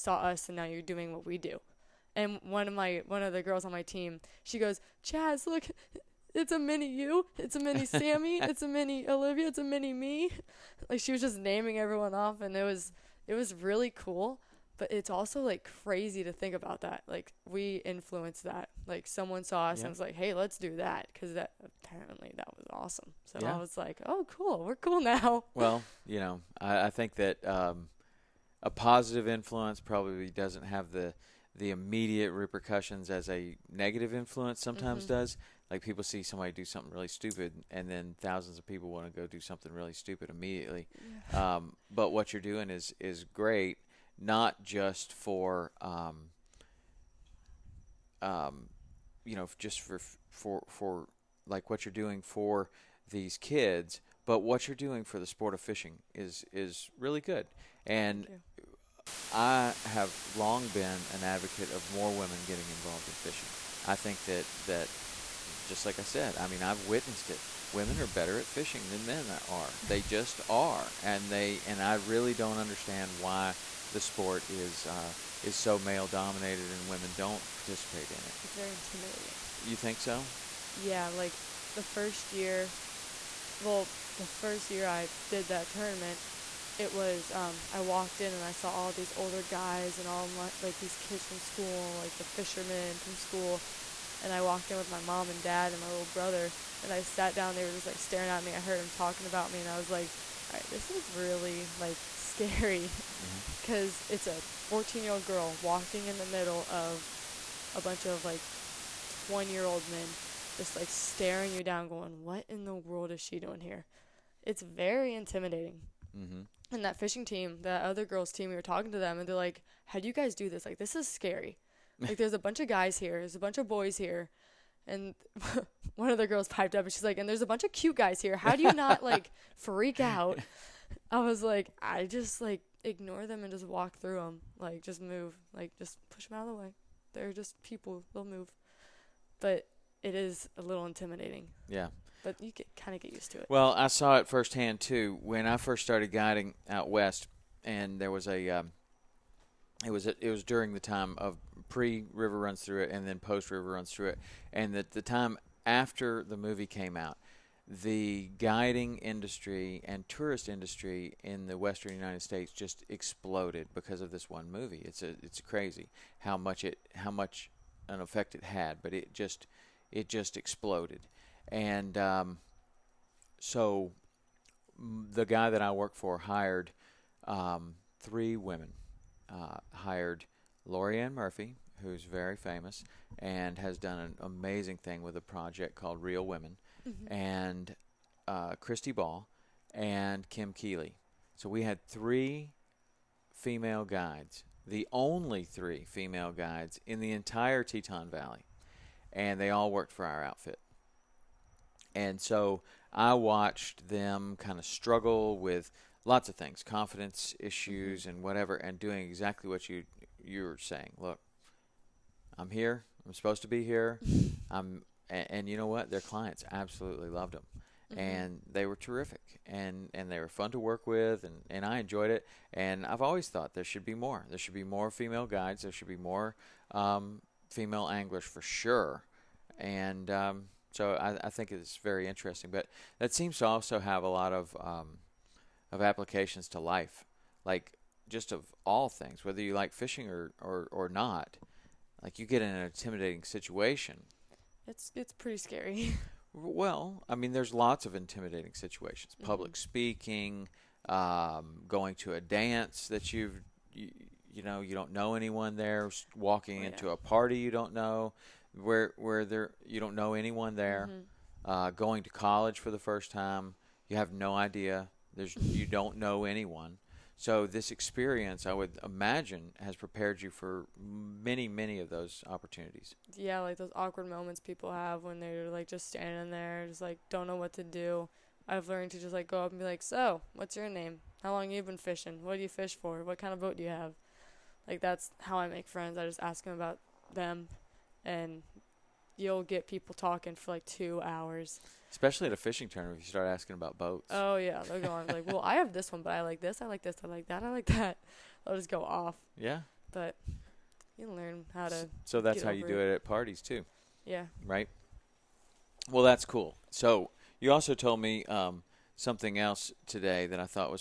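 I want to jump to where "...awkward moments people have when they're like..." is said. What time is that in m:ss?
4:33.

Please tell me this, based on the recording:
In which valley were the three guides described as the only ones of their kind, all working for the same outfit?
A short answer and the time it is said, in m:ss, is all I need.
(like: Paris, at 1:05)
Teton Valley, at 3:17.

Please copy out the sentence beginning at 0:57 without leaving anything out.
And I have long been an advocate of more women getting involved in fishing.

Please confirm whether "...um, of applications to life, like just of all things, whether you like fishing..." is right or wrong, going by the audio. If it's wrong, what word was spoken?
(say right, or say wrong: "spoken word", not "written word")
right.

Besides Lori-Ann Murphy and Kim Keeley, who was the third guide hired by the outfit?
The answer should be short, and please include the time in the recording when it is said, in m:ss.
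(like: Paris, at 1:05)
Christy Ball, at 3:08.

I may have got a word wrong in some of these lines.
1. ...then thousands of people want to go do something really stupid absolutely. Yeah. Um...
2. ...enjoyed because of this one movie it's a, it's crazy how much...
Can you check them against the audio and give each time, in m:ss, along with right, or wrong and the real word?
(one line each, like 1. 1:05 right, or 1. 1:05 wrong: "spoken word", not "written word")
1. 0:37 wrong: "immediately", not "absolutely"
2. 2:42 wrong: "exploded", not "enjoyed".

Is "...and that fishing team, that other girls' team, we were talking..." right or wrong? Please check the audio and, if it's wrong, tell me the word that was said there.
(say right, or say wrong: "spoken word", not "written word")
right.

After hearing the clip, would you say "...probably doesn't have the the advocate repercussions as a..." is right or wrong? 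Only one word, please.
wrong.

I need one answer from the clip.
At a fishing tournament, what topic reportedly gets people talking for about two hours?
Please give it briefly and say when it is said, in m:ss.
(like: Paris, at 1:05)
Boats, at 4:53.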